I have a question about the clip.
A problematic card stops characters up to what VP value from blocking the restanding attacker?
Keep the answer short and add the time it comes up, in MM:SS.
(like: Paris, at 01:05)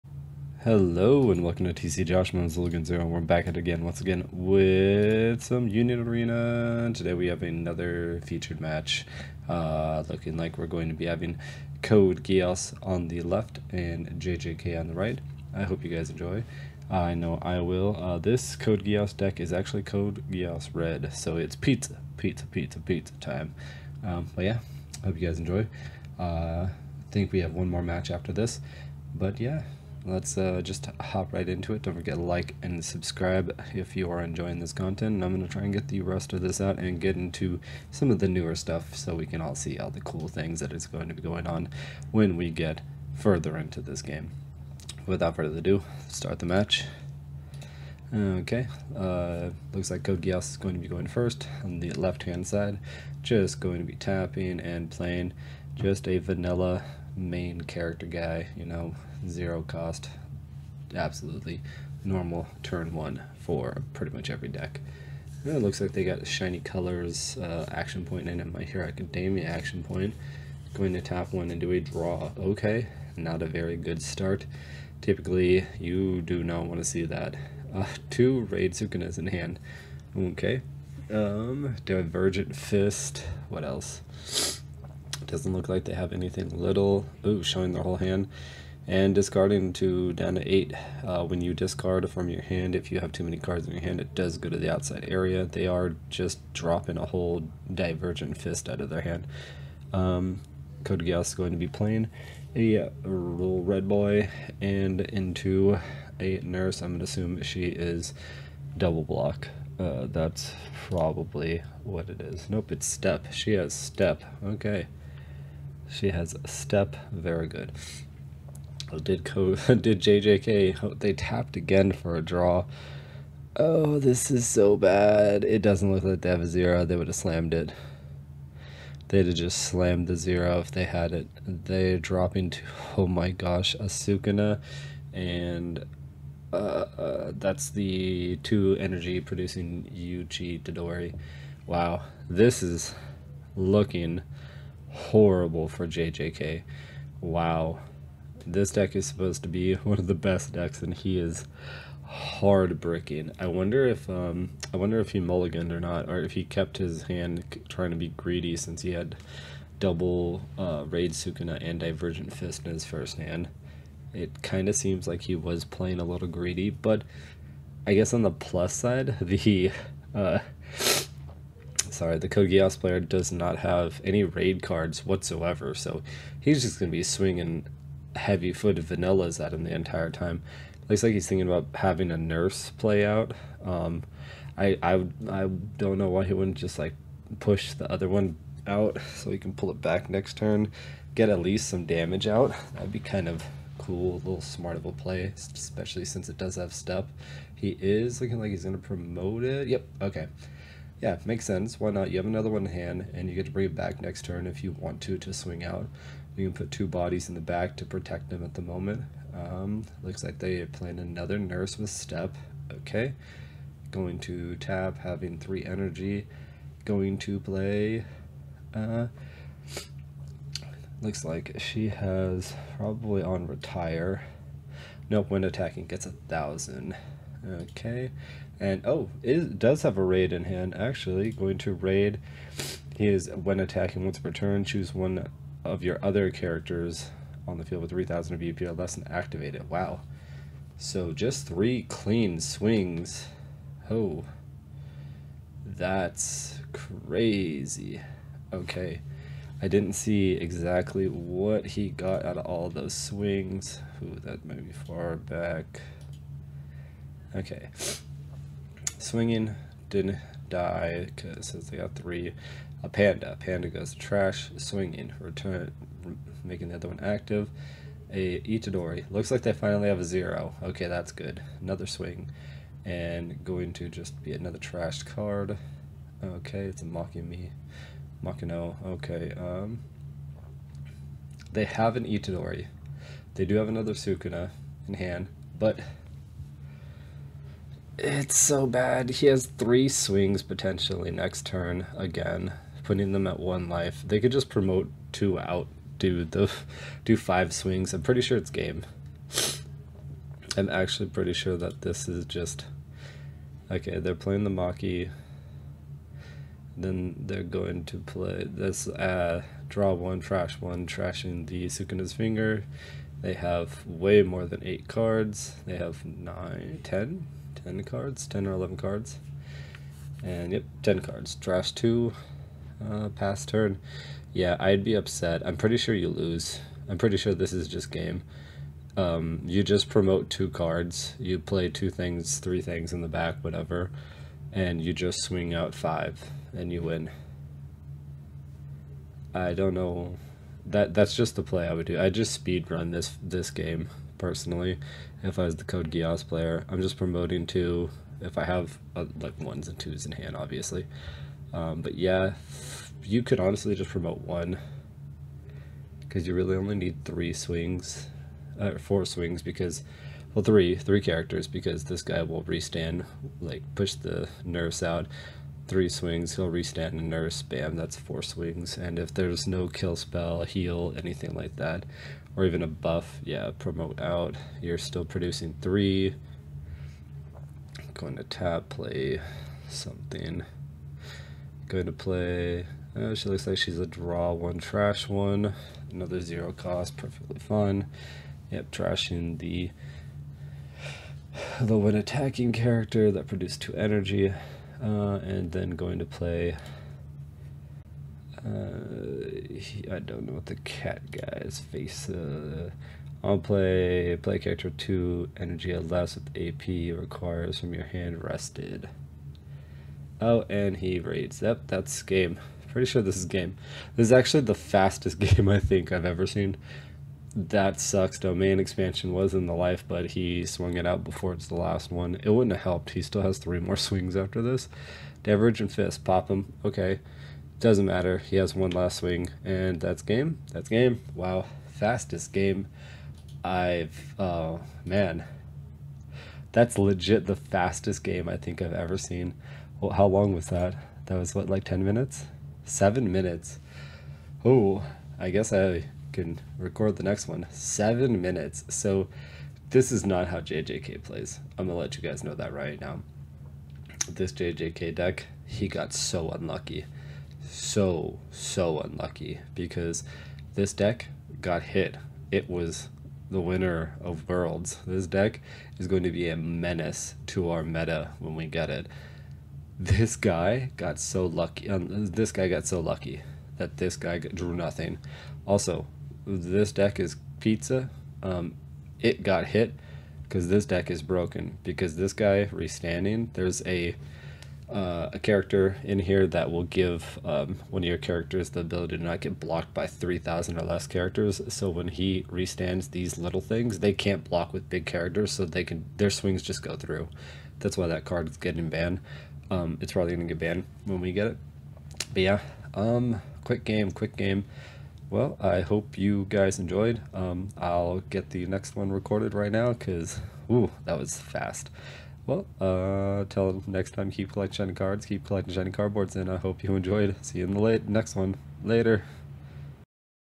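3,000, at 08:09.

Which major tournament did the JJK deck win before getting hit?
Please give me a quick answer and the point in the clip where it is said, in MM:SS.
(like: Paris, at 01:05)
Worlds, at 07:42.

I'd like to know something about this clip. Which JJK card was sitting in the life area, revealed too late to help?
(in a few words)
Domain expansion.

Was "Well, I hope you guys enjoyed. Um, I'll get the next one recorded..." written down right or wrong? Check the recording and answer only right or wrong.
right.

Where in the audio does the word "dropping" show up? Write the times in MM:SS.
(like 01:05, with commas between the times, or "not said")
01:36, 02:11.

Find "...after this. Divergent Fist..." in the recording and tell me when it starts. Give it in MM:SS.
07:04.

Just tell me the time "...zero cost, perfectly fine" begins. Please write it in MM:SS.
06:26.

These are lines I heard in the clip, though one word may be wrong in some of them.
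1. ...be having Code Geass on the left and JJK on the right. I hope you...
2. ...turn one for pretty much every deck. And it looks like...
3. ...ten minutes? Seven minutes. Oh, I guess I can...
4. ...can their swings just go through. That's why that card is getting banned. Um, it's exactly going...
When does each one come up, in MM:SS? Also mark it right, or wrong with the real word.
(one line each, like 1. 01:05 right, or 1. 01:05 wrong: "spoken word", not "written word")
1. 00:10 right
2. 01:02 right
3. 07:21 right
4. 08:15 wrong: "probably", not "exactly".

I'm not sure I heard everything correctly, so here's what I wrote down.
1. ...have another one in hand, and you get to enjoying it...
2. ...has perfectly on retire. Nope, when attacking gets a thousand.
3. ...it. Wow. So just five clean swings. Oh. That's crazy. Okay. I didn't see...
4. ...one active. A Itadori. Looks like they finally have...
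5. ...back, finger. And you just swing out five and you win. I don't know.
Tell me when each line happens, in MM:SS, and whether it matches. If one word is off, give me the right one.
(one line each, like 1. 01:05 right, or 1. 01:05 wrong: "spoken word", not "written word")
1. 03:22 wrong: "bring", not "enjoying"
2. 03:41 wrong: "probably", not "perfectly"
3. 03:59 wrong: "three", not "five"
4. 04:26 right
5. 05:33 wrong: "whatever", not "finger".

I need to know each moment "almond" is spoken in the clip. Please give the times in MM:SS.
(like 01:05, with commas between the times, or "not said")
not said.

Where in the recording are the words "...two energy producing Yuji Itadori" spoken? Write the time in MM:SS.
02:18.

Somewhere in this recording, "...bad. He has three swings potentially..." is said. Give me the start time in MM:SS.
04:48.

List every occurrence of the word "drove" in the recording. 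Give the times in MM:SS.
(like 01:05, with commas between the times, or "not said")
not said.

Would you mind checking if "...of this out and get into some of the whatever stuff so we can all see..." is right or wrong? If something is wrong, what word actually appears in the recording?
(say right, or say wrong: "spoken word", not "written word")
wrong: "newer", not "whatever".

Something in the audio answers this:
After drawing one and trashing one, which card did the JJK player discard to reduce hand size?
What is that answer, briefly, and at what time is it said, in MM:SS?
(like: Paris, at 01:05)
Sukuna's finger, at 05:10.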